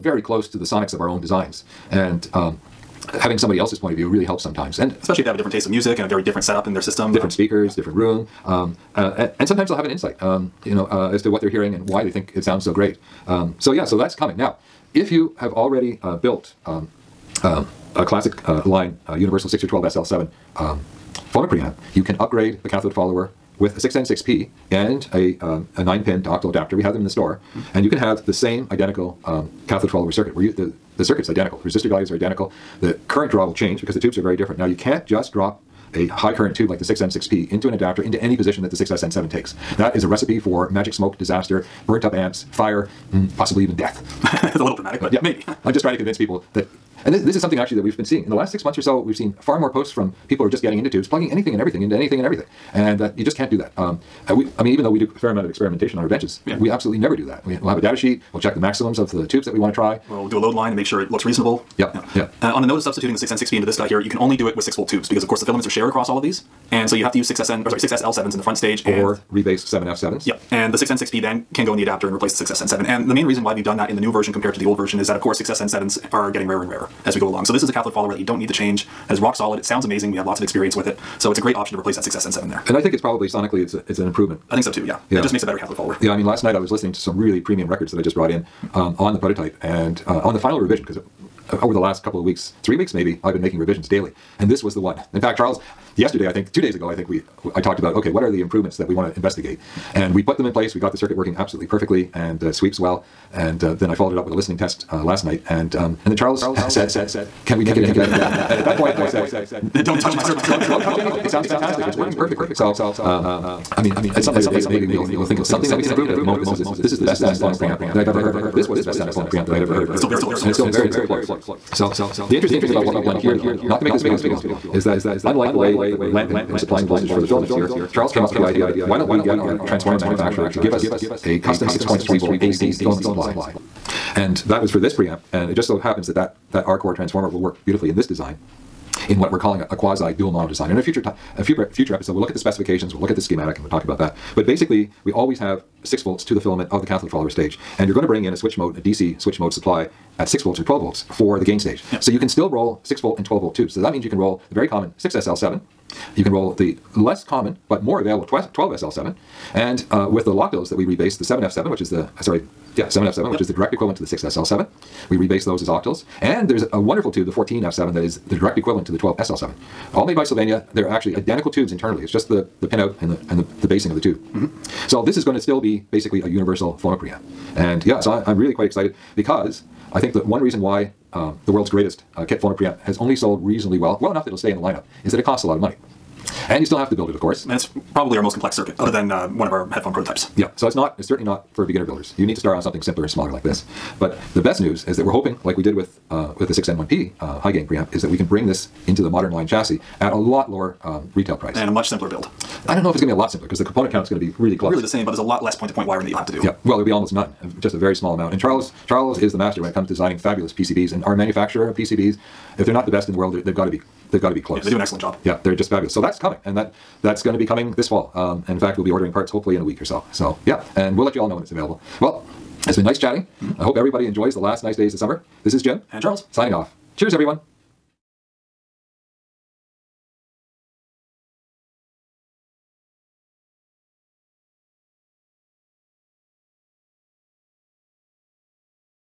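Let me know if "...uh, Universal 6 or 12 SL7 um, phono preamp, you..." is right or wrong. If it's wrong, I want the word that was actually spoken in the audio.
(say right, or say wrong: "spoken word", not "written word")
right.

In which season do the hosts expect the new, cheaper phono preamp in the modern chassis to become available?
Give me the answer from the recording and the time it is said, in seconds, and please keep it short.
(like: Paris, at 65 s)
Fall, at 217 s.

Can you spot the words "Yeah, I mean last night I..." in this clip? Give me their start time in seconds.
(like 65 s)
86 s.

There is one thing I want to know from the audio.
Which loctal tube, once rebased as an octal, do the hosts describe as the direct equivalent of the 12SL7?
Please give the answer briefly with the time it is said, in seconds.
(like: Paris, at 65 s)
14F7, at 167 s.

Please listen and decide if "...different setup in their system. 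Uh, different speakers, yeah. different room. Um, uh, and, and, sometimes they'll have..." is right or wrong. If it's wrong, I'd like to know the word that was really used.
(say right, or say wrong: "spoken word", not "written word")
right.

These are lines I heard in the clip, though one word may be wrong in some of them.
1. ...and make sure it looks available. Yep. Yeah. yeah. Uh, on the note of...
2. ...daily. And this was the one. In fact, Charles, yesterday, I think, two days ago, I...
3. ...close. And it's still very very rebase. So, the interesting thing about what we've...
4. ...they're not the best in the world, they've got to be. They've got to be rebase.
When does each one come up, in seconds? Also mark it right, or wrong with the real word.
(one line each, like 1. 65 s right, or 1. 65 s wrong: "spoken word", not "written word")
1. 60 s wrong: "reasonable", not "available"
2. 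93 s right
3. 120 s wrong: "close", not "rebase"
4. 212 s wrong: "close", not "rebase".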